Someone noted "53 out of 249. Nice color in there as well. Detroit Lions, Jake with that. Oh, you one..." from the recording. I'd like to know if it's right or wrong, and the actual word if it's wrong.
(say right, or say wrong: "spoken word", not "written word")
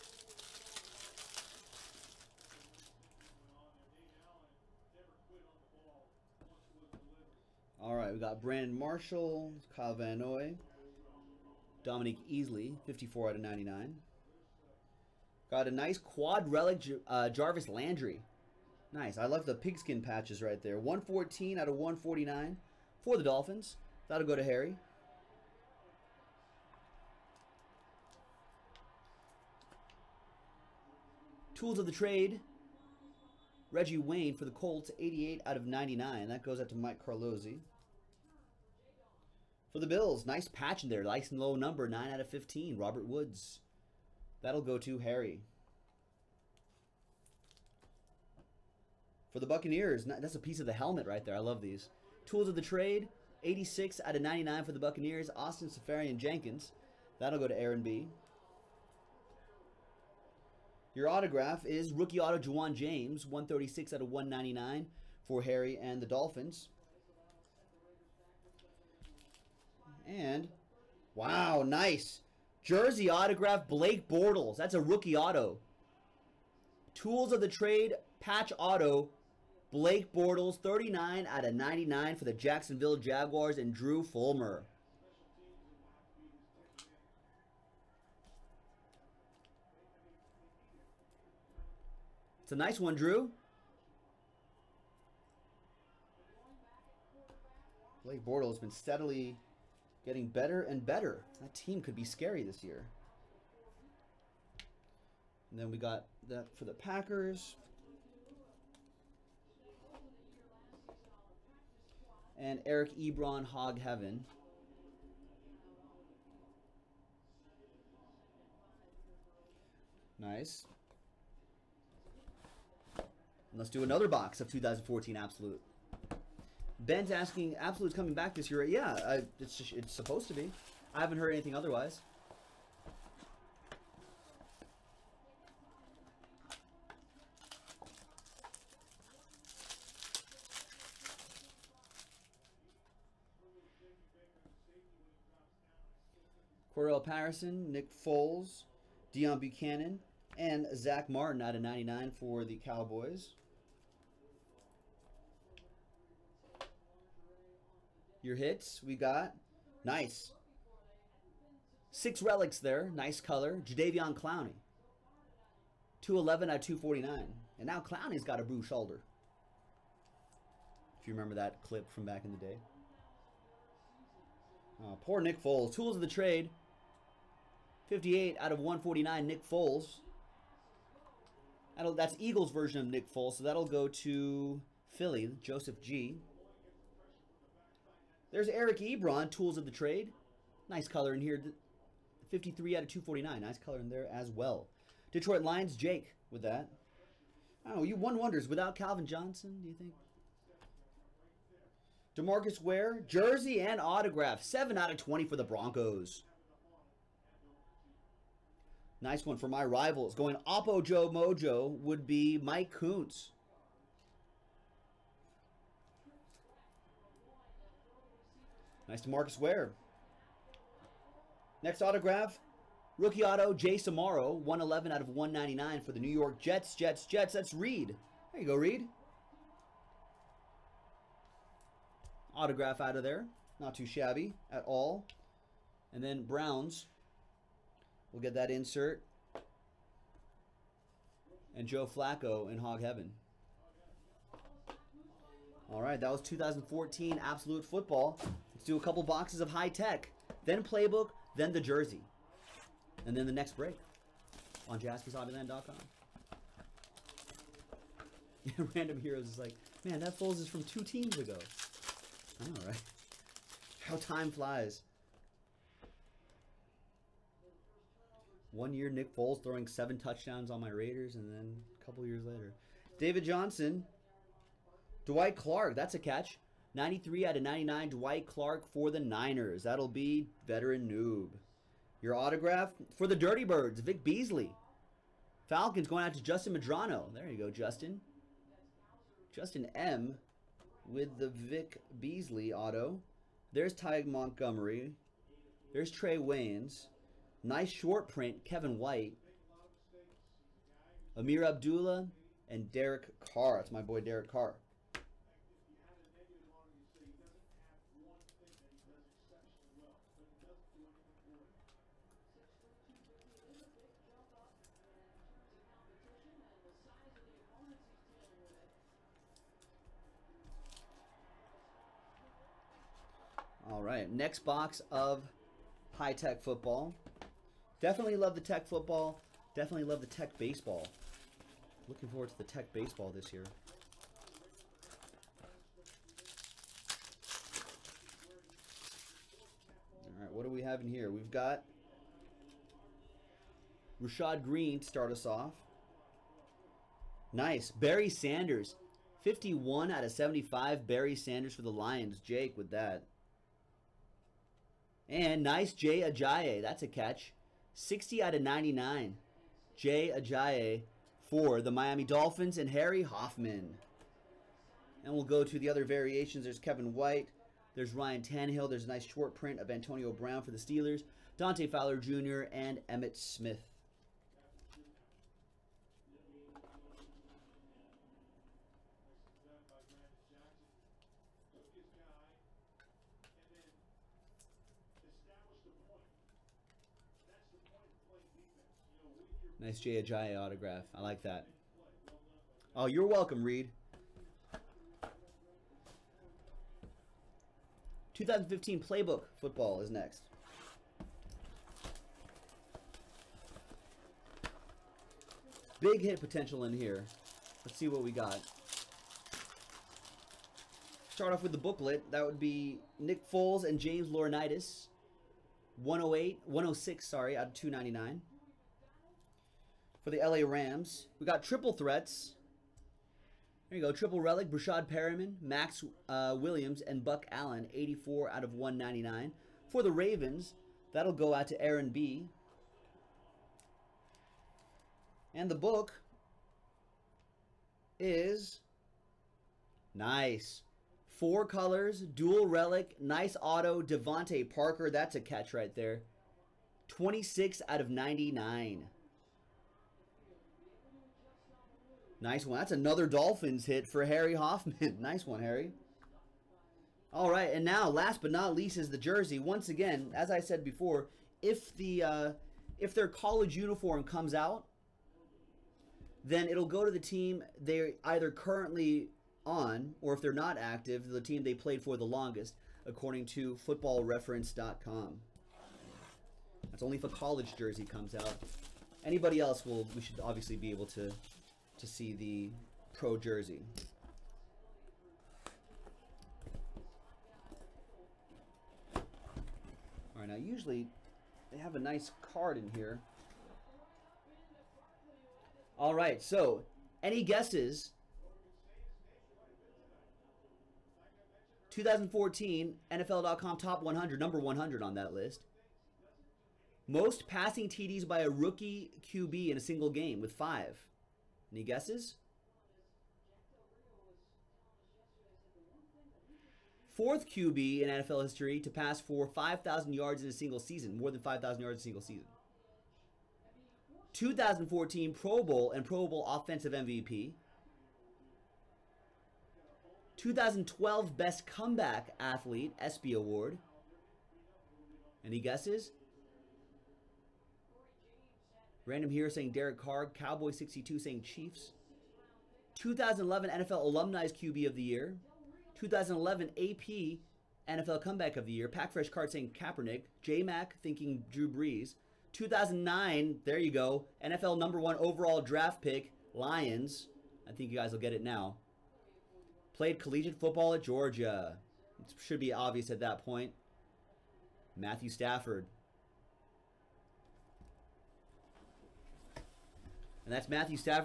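right.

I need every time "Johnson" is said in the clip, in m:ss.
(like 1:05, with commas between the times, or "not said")
3:19, 4:33.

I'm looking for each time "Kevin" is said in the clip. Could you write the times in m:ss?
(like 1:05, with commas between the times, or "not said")
4:58, 6:06.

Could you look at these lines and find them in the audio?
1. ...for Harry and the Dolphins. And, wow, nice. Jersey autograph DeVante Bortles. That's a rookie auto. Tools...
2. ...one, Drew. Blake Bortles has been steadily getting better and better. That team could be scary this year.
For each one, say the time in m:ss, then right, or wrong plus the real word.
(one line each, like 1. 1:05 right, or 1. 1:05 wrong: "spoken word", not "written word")
1. 1:05 wrong: "Blake", not "DeVante"
2. 1:32 right.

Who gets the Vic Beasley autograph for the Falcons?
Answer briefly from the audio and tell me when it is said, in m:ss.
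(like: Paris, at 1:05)
Justin Madrano, at 4:46.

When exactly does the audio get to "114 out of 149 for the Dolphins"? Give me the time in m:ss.
0:20.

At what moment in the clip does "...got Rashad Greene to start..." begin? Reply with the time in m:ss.
5:41.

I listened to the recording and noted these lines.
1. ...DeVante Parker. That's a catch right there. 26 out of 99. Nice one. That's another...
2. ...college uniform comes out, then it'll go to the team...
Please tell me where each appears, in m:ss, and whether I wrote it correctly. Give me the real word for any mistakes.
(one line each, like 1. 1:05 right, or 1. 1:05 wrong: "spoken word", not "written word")
1. 7:23 right
2. 7:43 right.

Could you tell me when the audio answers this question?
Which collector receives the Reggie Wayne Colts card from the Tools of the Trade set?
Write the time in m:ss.
0:36.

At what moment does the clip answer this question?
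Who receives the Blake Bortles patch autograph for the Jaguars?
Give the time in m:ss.
1:23.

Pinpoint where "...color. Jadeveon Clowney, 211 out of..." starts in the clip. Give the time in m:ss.
2:43.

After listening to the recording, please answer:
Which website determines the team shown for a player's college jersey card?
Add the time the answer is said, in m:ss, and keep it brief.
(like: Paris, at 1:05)
footballreference.com, at 7:53.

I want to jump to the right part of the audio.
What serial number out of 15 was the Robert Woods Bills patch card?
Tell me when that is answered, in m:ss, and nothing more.
0:41.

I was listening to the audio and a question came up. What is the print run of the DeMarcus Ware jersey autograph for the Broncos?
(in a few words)
20.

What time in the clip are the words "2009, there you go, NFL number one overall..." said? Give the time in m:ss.
9:12.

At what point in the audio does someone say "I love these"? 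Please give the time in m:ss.
0:51.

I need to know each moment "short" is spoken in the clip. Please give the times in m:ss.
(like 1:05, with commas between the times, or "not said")
4:57, 6:09.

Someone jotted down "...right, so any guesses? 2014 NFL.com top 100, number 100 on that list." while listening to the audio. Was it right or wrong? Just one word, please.
right.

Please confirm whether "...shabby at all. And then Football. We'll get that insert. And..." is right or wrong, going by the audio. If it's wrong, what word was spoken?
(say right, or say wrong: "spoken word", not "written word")
wrong: "Browns", not "Football".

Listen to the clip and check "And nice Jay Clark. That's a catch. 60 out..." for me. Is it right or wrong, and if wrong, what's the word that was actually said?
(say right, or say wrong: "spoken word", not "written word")
wrong: "Ajayi", not "Clark".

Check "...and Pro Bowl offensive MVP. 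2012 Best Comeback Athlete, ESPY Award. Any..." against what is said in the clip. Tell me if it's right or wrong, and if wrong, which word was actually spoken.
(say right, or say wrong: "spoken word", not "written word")
right.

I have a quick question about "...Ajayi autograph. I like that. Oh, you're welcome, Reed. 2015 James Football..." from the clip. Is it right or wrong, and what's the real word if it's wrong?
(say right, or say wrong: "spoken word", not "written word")
wrong: "Playbook", not "James".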